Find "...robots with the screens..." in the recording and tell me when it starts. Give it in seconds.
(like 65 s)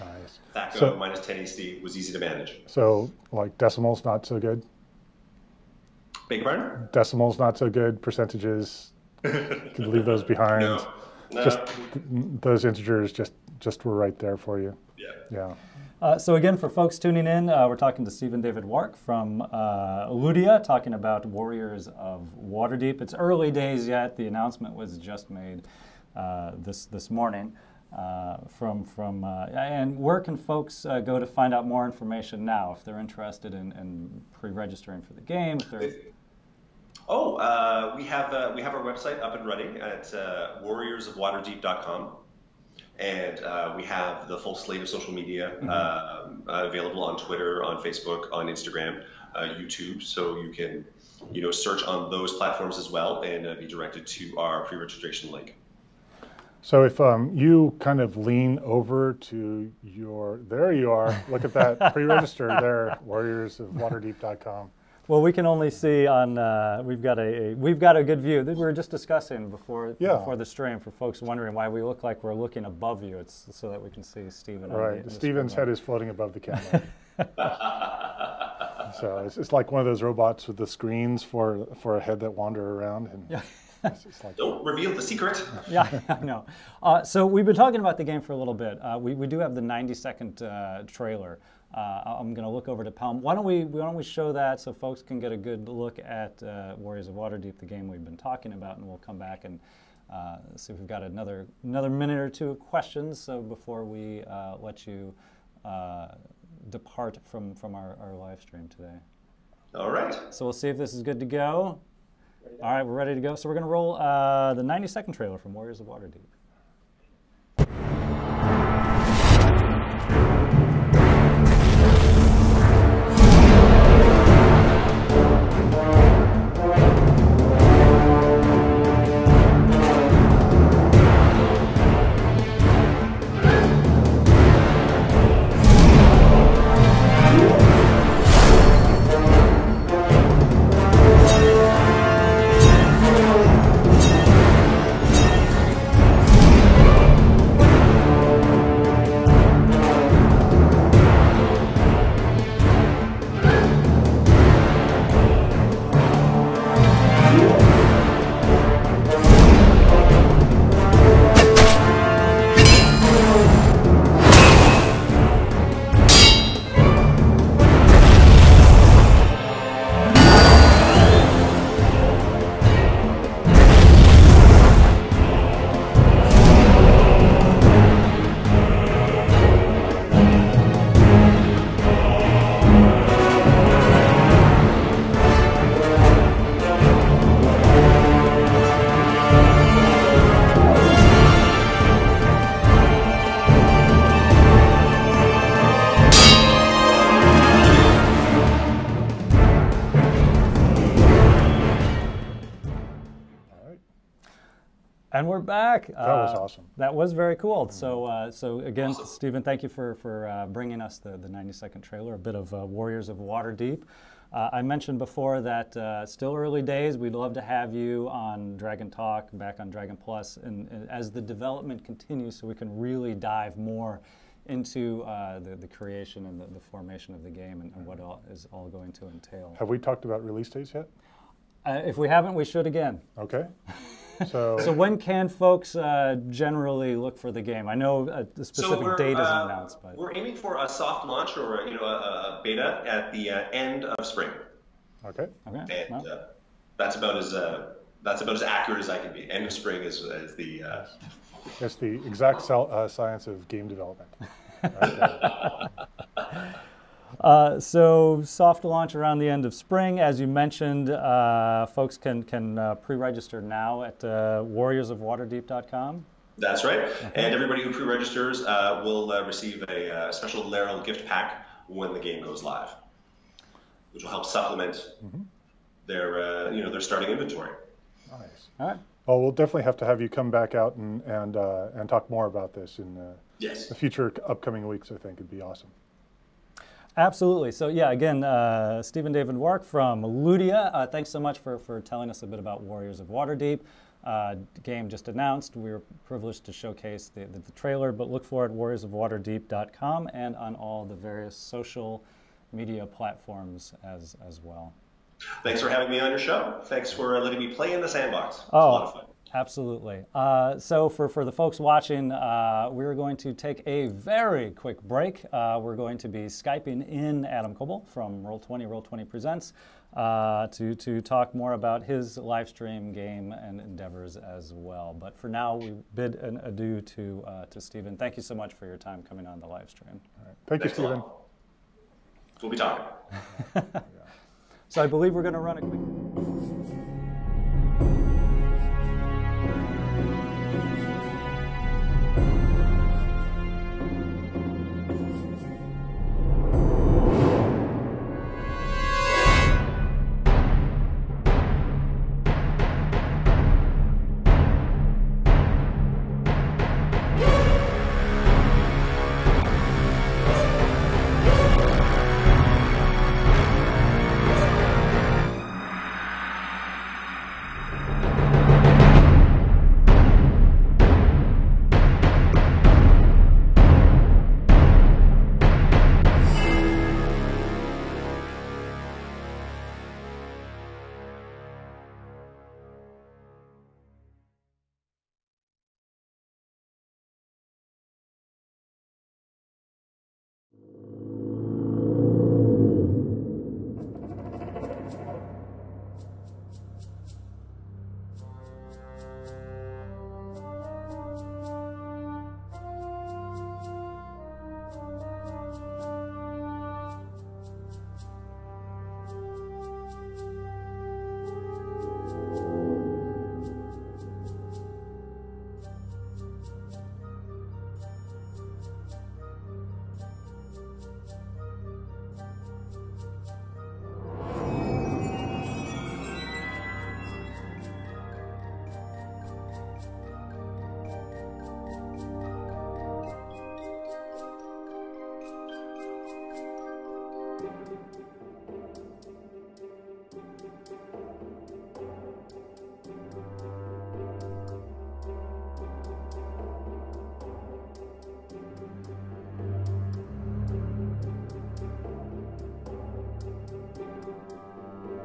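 80 s.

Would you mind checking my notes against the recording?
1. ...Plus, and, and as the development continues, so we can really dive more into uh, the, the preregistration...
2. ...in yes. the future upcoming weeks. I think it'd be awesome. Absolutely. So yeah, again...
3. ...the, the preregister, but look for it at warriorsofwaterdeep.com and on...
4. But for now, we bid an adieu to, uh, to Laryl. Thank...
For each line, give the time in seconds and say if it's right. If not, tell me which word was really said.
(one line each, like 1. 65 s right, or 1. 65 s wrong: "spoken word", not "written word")
1. 219 s wrong: "creation", not "preregistration"
2. 282 s right
3. 297 s wrong: "trailer", not "preregister"
4. 324 s wrong: "Stephen", not "Laryl".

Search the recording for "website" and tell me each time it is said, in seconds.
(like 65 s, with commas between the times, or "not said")
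38 s.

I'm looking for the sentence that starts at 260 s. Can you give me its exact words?
Uh, folks can can uh, pre-register now at uh, warriorsofwaterdeep.com.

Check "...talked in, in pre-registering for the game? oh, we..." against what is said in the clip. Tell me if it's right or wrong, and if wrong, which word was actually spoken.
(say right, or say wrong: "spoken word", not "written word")
wrong: "interested", not "talked".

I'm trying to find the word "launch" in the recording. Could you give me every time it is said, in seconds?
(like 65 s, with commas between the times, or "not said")
241 s, 258 s.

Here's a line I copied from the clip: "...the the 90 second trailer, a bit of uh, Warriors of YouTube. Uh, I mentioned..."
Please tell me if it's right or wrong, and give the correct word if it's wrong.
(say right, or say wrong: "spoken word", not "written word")
wrong: "Waterdeep", not "YouTube".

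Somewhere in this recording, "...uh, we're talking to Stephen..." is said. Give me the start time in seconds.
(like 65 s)
17 s.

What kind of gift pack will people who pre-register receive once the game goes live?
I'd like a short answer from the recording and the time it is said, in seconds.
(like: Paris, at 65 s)
Laryl gift pack, at 270 s.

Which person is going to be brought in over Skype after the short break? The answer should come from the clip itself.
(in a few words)
Adam Koebel.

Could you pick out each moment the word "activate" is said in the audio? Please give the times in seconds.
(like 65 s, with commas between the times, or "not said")
not said.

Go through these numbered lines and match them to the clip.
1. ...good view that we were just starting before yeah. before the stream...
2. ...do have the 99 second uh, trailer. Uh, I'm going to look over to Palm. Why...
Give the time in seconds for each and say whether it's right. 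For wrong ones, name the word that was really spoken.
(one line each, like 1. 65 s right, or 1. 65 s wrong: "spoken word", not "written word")
1. 68 s wrong: "discussing", not "starting"
2. 89 s wrong: "90", not "99".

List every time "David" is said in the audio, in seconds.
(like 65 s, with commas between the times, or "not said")
18 s, 289 s.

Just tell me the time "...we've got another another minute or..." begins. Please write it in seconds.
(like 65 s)
100 s.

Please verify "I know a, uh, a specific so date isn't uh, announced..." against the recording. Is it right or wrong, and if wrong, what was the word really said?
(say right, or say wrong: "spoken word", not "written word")
right.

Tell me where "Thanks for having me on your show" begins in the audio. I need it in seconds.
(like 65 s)
305 s.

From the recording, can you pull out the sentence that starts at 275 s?
their you know their starting inventory.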